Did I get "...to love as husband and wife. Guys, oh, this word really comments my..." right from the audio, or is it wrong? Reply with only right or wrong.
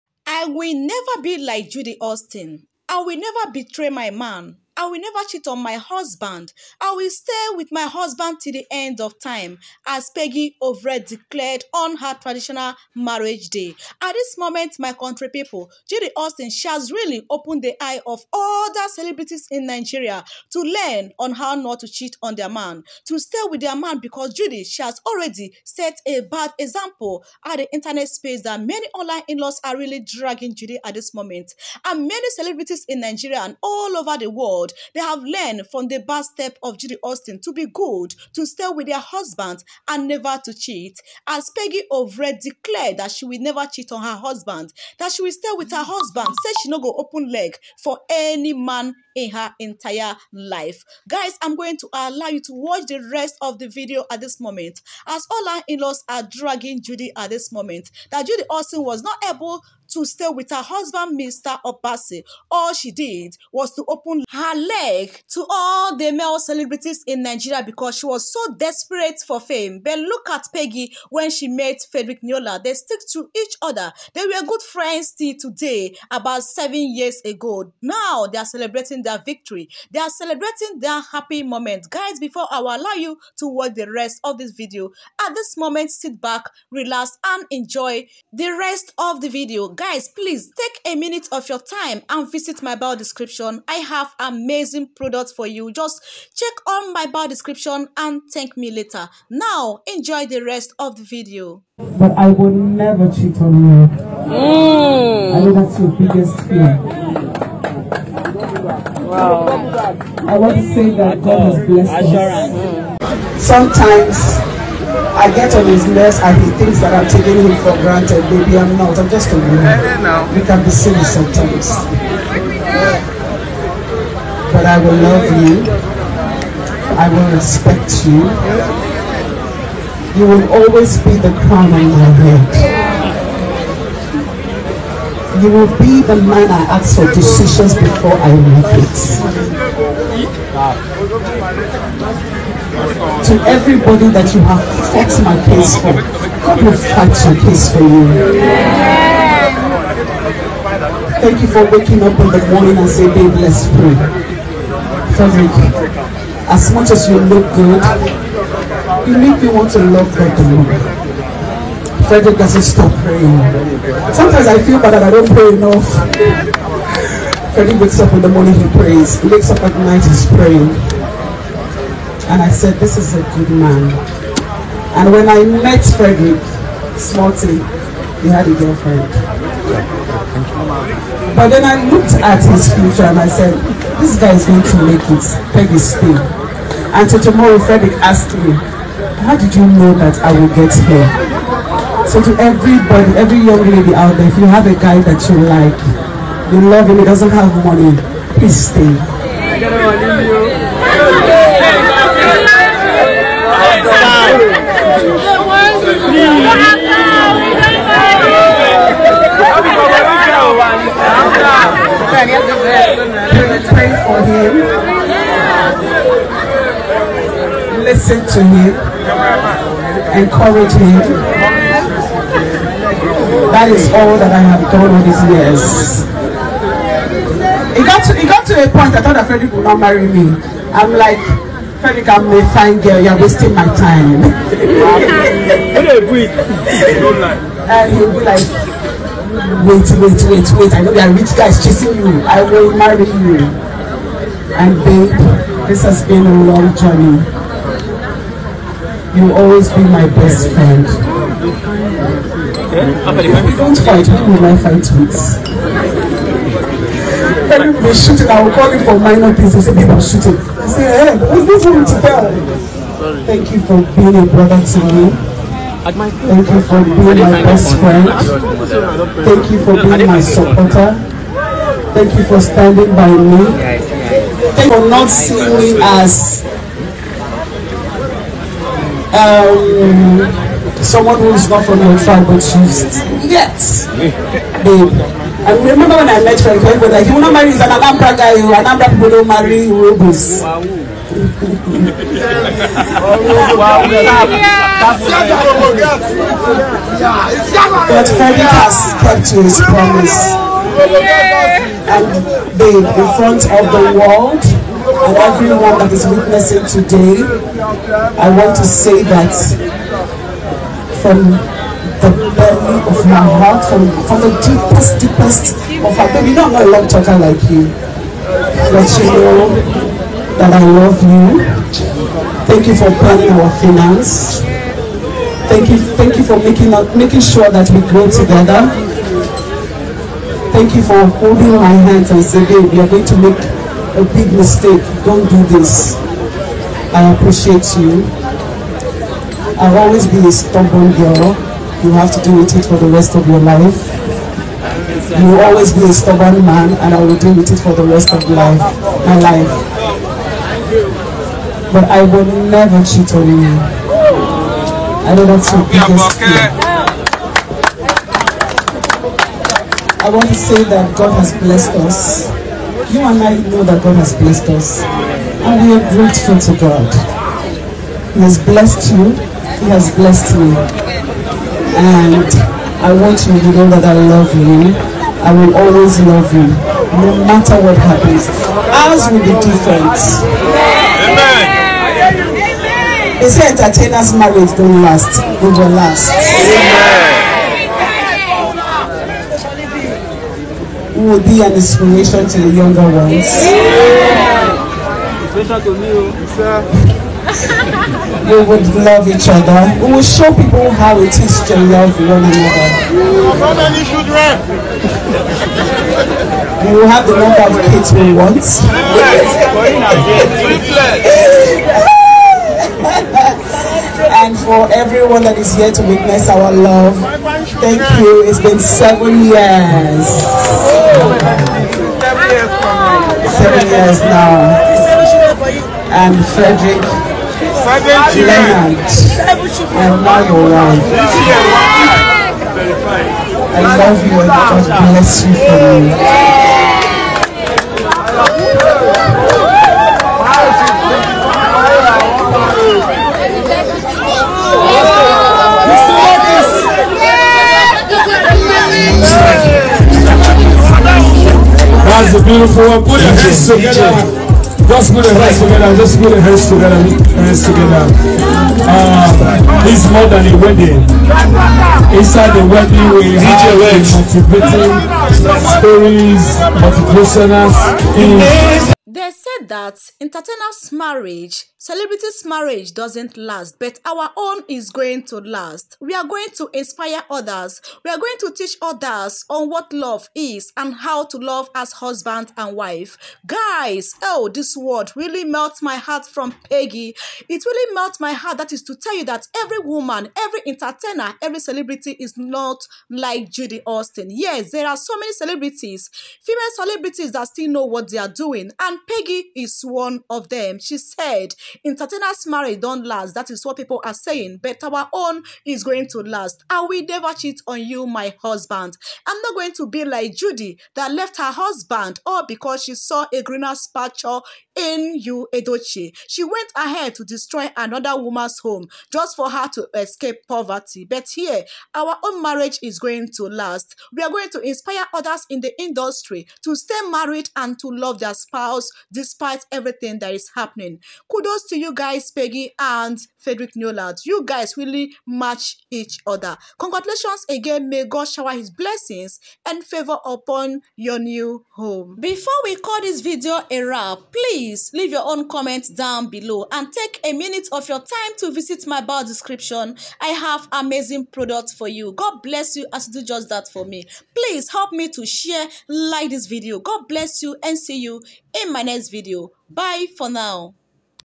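wrong.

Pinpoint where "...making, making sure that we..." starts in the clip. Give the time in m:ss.
5:26.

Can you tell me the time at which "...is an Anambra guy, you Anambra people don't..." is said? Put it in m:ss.
4:47.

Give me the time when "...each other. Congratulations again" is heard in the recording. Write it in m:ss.
8:55.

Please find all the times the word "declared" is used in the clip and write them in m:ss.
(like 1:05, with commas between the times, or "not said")
0:11, 0:42.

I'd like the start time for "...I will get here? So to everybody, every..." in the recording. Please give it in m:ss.
3:10.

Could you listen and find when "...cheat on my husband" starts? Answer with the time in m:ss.
0:05.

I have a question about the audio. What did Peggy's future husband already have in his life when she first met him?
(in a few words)
A girlfriend.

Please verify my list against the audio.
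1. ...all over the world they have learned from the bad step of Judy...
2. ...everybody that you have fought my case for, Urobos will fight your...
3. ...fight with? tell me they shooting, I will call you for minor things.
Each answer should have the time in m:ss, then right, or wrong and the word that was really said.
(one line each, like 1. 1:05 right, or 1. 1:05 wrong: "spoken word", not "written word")
1. 0:33 right
2. 2:23 wrong: "God", not "Urobos"
3. 4:14 right.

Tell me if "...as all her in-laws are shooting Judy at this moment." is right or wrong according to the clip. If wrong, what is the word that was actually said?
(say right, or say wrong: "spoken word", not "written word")
wrong: "dragging", not "shooting".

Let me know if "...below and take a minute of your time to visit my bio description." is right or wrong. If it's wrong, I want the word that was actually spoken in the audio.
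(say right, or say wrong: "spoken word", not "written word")
right.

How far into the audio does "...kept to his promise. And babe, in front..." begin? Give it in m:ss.
4:59.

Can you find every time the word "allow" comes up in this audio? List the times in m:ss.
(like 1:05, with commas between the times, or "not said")
0:51, 1:22.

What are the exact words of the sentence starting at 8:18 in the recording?
And Peggy is one of them.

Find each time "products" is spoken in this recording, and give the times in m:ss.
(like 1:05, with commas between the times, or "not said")
1:34, 9:11.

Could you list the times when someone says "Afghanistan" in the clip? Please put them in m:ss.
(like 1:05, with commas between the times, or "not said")
not said.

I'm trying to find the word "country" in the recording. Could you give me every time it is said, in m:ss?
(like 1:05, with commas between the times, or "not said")
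0:14.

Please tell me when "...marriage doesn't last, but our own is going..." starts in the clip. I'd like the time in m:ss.
7:52.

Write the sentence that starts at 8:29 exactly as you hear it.
I'm not going to be like Judy that left her husband all because she saw a greener picture in you, Edochie.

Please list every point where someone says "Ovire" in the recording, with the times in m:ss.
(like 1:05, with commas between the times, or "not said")
0:10, 0:41.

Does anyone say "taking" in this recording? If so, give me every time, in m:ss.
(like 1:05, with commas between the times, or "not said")
1:57.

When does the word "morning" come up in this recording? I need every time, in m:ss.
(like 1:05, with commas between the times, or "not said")
2:32, 2:48.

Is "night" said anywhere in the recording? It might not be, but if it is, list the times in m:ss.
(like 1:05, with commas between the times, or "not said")
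2:49.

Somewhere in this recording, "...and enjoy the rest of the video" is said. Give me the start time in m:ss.
1:27.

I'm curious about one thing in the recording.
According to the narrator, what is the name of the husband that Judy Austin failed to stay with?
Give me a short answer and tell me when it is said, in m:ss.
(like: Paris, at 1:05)
Mr. Obasi, at 1:01.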